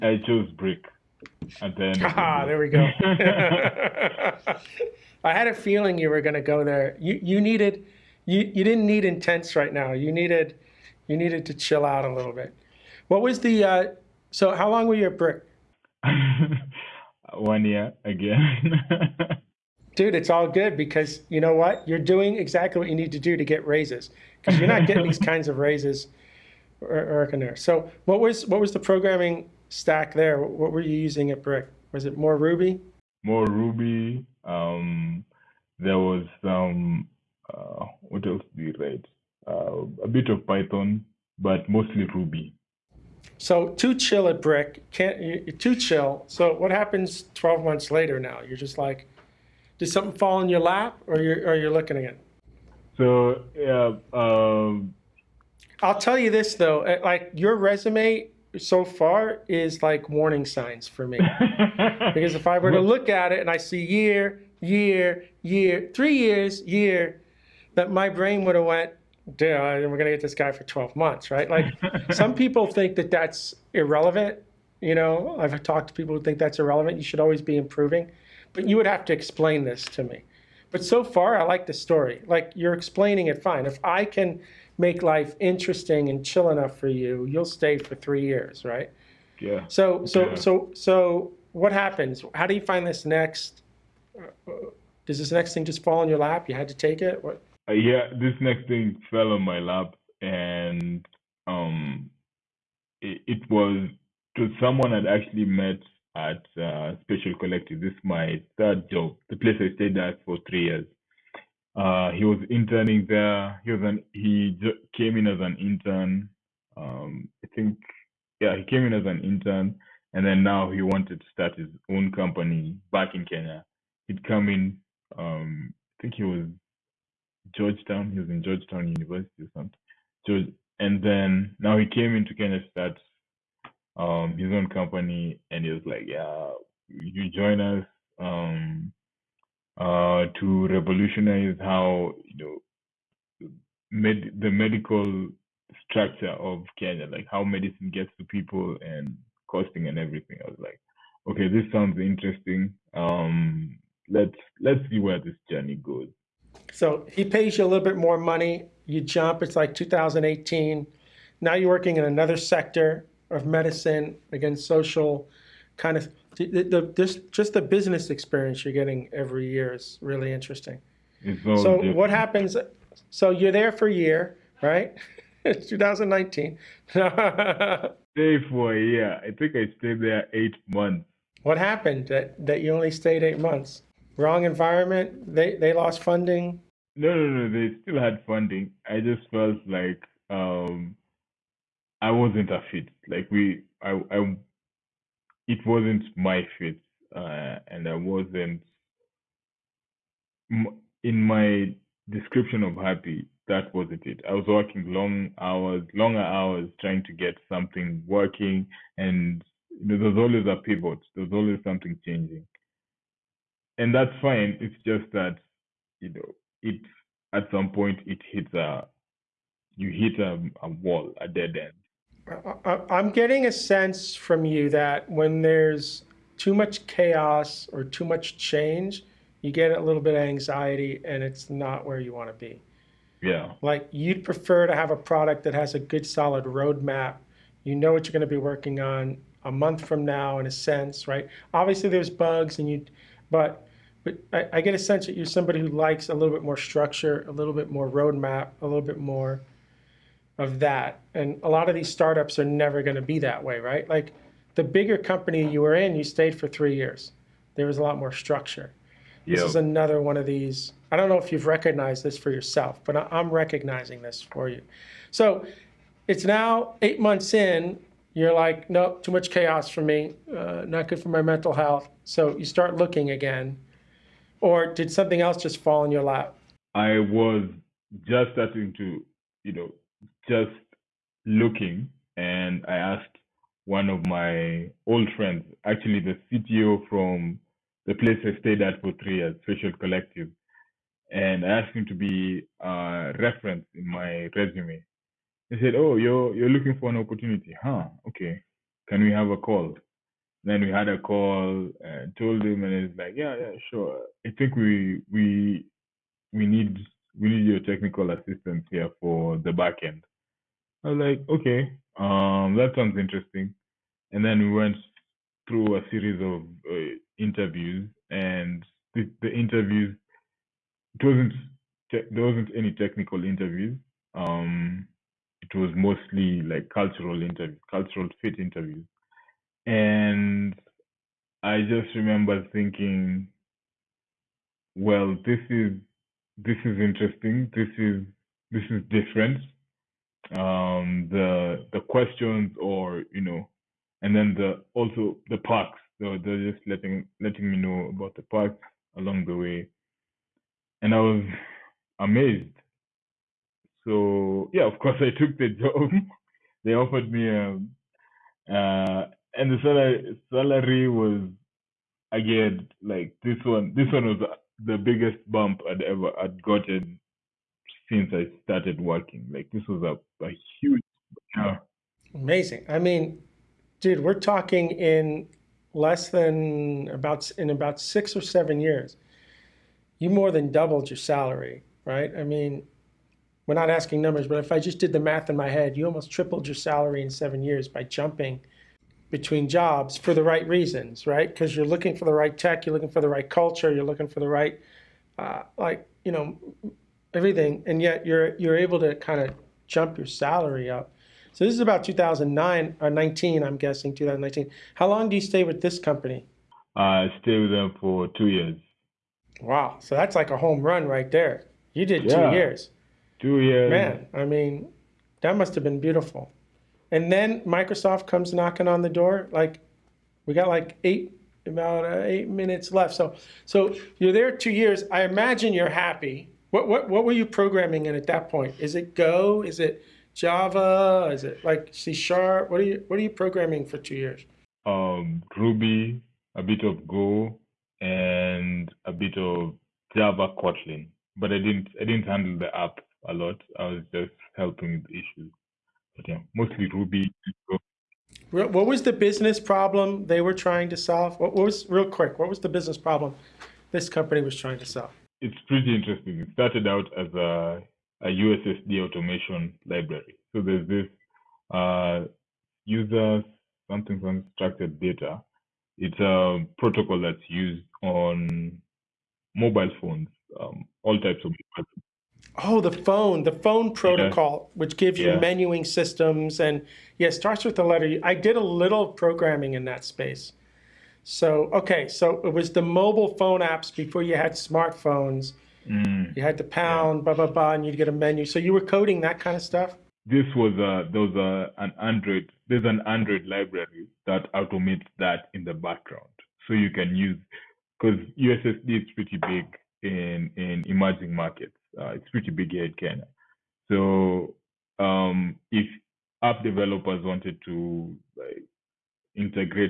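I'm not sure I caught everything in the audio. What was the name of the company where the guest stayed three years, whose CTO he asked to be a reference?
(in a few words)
Social Collective.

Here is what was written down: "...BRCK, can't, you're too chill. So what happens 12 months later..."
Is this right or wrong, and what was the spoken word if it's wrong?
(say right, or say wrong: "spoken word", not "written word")
right.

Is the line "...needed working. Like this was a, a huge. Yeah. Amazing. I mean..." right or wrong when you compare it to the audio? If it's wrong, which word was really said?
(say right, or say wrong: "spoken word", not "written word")
wrong: "started", not "needed".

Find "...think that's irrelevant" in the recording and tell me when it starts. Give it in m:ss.
1:16.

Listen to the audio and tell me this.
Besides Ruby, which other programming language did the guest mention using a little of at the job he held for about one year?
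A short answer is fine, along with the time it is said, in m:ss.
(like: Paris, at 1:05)
Python, at 0:40.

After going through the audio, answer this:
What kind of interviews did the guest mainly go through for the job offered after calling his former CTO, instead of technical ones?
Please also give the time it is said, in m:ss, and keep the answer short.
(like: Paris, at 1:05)
Cultural fit interviews, at 5:27.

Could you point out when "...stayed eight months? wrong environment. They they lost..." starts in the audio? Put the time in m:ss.
3:02.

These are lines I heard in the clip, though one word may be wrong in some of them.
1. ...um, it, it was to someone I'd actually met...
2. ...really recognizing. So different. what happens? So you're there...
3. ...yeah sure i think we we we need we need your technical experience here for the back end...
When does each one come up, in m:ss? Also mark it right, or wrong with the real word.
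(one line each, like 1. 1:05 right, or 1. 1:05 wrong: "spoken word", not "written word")
1. 1:41 right
2. 2:50 wrong: "interesting", not "recognizing"
3. 5:03 wrong: "assistance", not "experience".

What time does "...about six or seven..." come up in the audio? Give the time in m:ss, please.
6:17.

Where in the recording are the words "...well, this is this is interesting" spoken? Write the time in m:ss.
5:34.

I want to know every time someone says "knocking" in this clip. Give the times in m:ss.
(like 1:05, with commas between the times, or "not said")
6:58.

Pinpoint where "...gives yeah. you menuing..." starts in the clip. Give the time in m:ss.
7:54.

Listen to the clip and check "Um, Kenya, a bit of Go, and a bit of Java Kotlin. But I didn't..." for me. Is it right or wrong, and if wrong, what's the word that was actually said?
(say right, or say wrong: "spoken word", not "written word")
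wrong: "Ruby", not "Kenya".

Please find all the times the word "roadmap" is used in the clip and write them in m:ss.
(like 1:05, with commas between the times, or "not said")
3:56, 4:07.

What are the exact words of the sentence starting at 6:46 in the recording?
Uh, I stayed with them for two years.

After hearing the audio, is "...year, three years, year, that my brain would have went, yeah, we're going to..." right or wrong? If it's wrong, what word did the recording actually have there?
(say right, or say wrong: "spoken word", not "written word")
right.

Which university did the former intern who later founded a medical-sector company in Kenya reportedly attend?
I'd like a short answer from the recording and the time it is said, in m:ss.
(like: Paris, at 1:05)
Georgetown University, at 2:08.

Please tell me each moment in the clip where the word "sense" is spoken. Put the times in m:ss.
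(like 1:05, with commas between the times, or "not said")
3:43, 4:00, 4:04.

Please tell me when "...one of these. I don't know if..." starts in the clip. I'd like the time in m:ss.
4:20.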